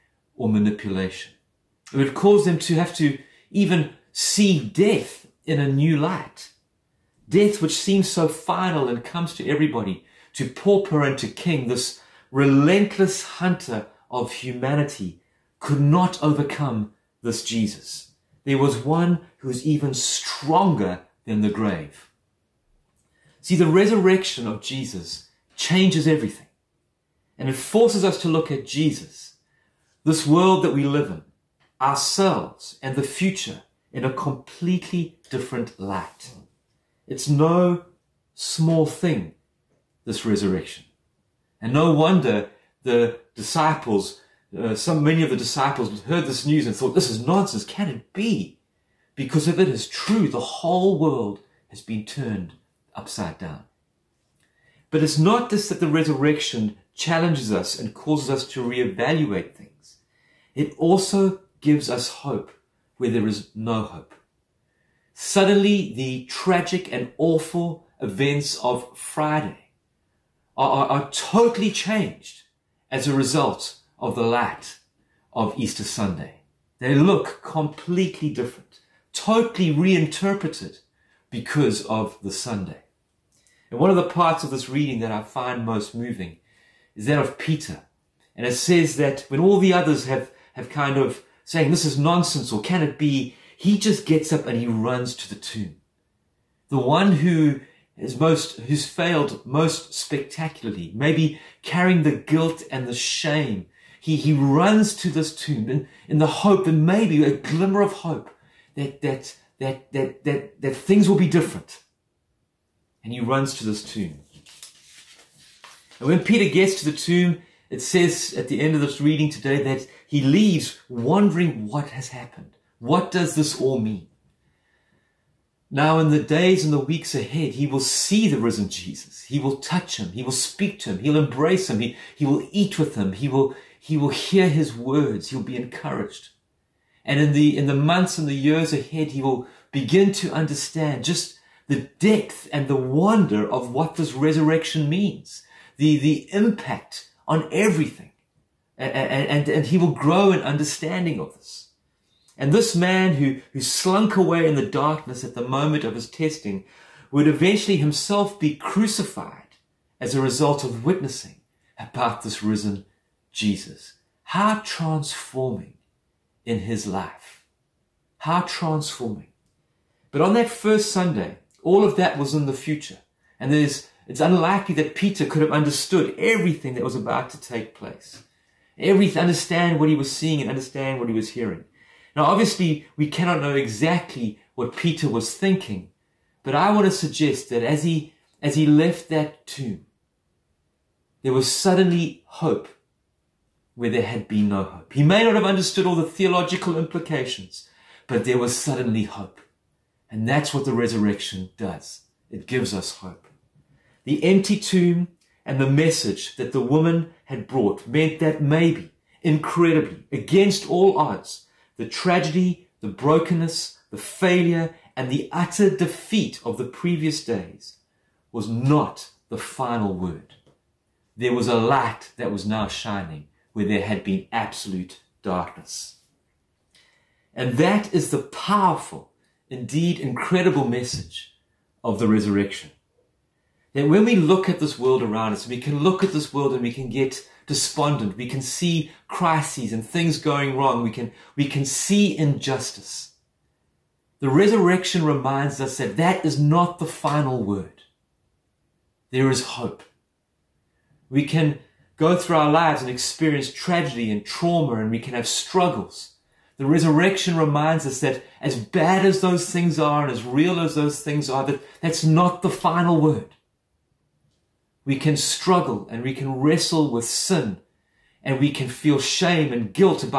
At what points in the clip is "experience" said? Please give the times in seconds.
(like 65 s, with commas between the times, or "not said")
252 s.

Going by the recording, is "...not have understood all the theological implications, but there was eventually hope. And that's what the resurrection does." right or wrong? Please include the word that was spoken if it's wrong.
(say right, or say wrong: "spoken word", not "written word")
wrong: "suddenly", not "eventually".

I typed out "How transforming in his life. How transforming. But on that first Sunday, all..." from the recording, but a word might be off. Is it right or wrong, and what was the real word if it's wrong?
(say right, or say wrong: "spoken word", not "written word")
right.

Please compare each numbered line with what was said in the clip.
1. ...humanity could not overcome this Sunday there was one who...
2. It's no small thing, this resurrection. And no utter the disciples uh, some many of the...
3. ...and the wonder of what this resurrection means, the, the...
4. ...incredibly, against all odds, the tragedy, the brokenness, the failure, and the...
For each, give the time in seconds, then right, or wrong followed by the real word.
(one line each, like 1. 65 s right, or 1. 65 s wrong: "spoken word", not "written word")
1. 14 s wrong: "Jesus", not "Sunday"
2. 37 s wrong: "wonder", not "utter"
3. 142 s right
4. 209 s right.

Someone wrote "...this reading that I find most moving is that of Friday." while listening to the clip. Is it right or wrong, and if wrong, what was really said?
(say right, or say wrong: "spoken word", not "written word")
wrong: "Peter", not "Friday".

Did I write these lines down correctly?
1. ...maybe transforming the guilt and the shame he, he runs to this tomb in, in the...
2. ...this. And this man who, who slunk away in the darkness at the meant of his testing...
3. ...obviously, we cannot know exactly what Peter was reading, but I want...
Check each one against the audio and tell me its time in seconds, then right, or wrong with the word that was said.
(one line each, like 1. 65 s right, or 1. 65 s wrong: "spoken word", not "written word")
1. 100 s wrong: "carrying", not "transforming"
2. 151 s wrong: "moment", not "meant"
3. 182 s wrong: "thinking", not "reading".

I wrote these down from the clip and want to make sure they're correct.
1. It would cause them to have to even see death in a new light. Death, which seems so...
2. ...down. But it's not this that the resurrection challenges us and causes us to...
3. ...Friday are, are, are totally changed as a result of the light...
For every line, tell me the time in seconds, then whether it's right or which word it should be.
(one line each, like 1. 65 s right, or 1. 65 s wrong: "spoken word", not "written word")
1. 1 s right
2. 53 s right
3. 68 s right.